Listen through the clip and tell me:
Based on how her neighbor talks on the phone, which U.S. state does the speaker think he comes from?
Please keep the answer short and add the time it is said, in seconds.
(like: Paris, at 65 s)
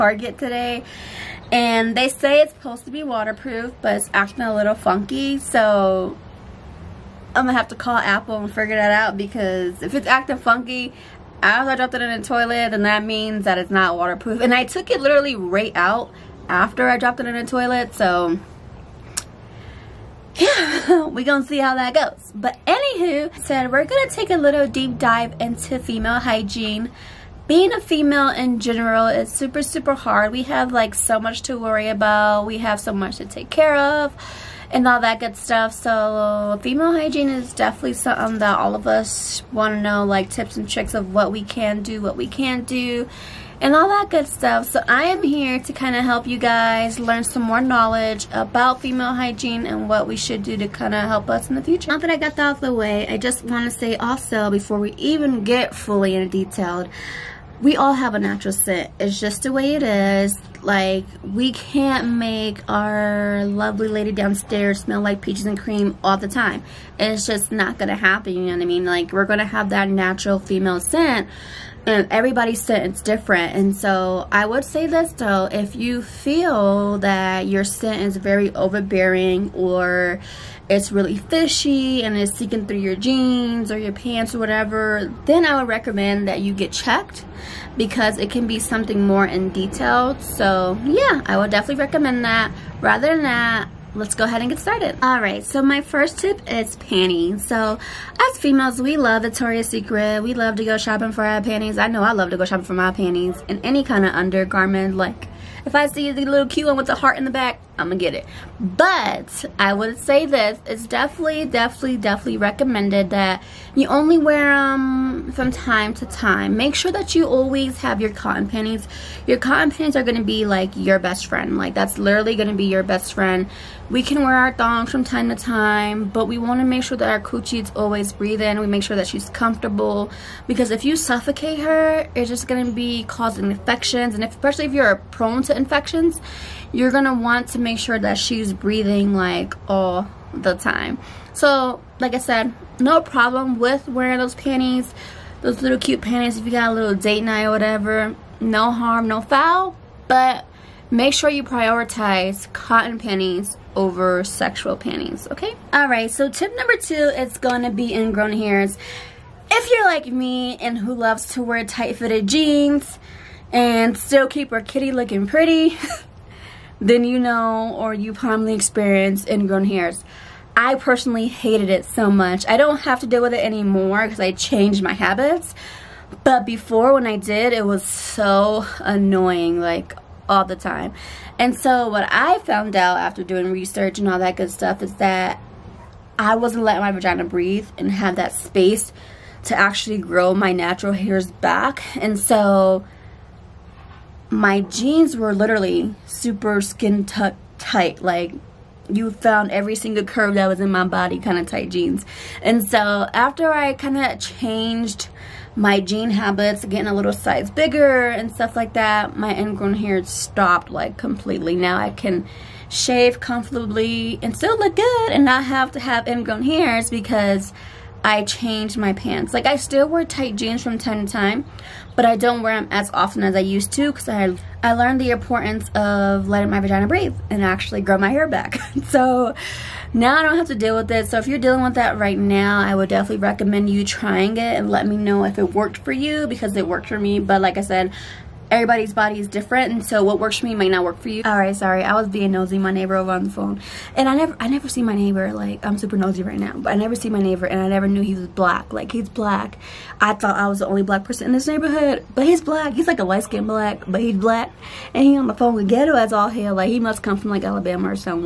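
Alabama, at 257 s.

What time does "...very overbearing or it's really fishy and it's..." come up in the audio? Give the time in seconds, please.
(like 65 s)
78 s.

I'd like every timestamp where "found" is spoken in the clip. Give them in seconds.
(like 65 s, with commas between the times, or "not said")
182 s, 199 s.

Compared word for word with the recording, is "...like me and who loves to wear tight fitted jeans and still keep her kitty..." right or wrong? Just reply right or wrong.
right.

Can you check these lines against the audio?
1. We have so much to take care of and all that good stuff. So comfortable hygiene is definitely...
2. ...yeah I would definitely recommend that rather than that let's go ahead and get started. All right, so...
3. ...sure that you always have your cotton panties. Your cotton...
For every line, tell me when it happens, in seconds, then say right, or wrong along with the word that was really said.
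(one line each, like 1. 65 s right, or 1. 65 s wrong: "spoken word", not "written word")
1. 32 s wrong: "female", not "comfortable"
2. 90 s right
3. 116 s right.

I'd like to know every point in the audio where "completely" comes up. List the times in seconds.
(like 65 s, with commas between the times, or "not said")
210 s.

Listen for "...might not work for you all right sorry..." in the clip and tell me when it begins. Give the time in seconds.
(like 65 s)
240 s.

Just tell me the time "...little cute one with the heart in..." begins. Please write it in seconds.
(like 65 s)
106 s.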